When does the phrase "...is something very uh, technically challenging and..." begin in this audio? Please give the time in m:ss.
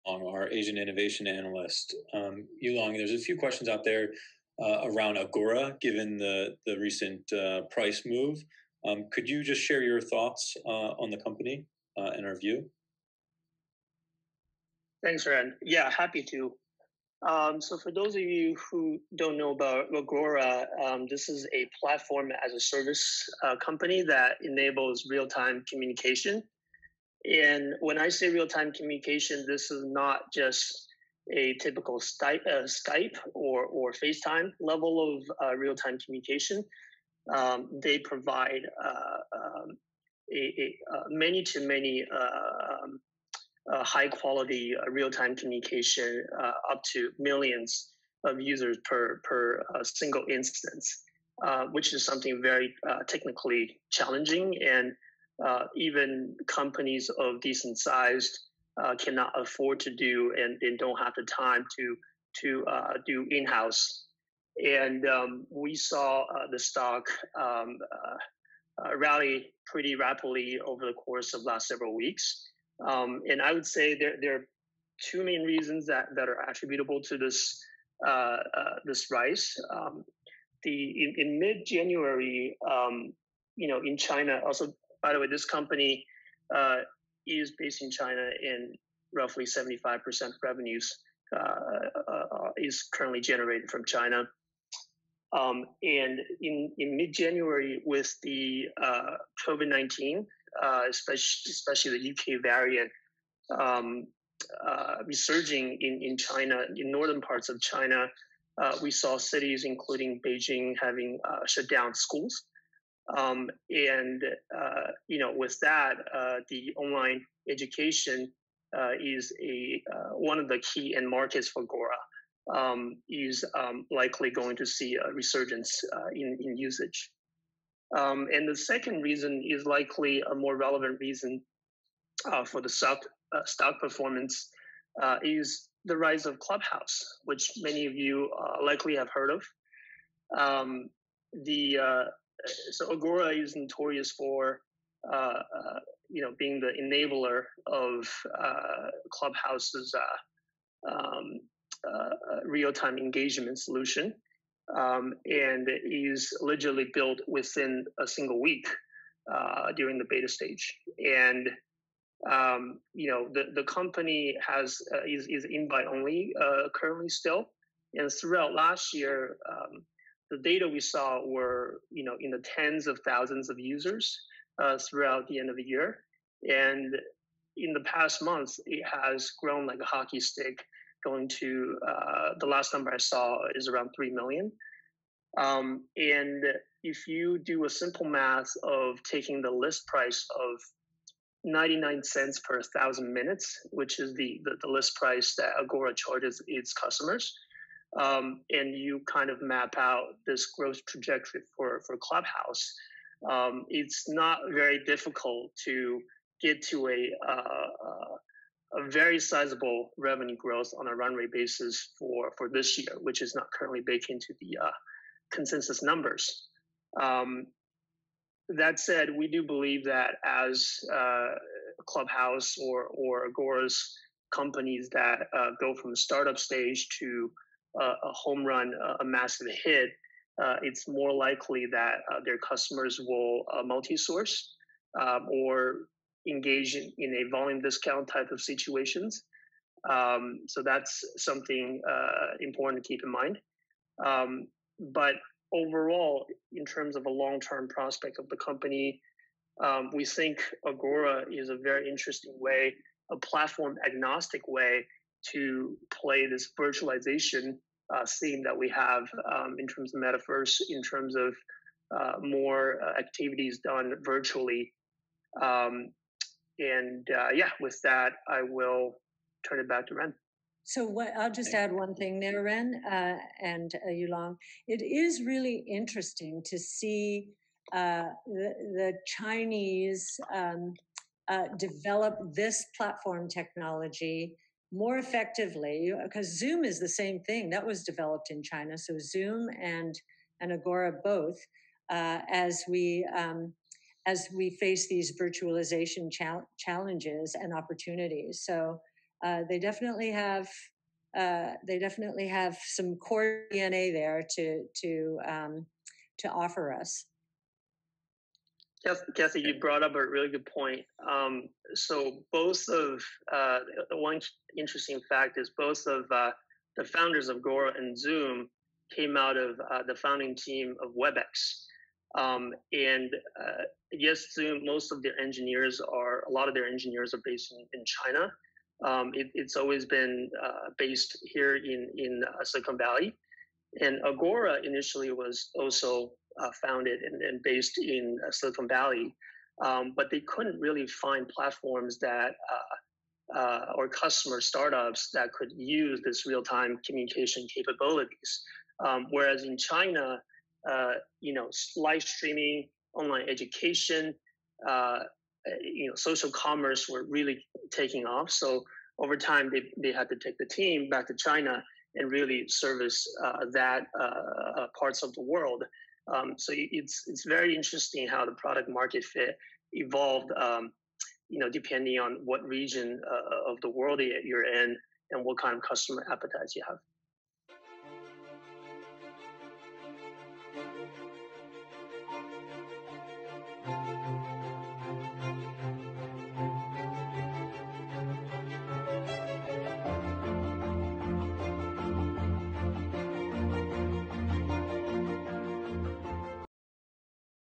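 0:51.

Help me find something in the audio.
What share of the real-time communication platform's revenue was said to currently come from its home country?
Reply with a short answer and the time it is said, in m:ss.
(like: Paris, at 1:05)
75%, at 1:29.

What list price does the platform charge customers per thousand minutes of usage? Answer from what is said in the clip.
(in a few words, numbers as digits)
99 cents.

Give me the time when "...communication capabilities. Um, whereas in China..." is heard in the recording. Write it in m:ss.
5:46.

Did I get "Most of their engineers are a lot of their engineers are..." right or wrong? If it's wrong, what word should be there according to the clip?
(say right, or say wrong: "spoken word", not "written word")
right.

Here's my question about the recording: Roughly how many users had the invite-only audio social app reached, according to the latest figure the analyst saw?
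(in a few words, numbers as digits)
3 million.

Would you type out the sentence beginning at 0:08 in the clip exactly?
Um, could you just share your thoughts uh, on the company uh, and our view?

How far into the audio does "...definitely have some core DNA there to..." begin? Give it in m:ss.
5:01.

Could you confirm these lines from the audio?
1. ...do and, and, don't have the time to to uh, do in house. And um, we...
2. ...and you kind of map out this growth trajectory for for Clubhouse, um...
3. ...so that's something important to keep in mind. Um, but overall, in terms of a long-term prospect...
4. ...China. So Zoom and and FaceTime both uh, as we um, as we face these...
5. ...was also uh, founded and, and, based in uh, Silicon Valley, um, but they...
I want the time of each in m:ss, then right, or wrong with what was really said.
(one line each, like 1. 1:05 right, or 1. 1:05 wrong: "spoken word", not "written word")
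1. 0:59 right
2. 3:18 right
3. 4:00 right
4. 4:48 wrong: "Agora", not "FaceTime"
5. 5:35 right.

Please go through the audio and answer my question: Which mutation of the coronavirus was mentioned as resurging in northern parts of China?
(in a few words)
UK variant.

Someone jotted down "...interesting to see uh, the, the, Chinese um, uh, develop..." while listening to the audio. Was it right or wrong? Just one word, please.
right.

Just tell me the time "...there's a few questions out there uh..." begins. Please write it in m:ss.
0:02.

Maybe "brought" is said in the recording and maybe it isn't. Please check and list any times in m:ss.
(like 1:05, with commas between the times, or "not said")
5:09.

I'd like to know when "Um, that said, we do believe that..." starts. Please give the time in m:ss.
3:37.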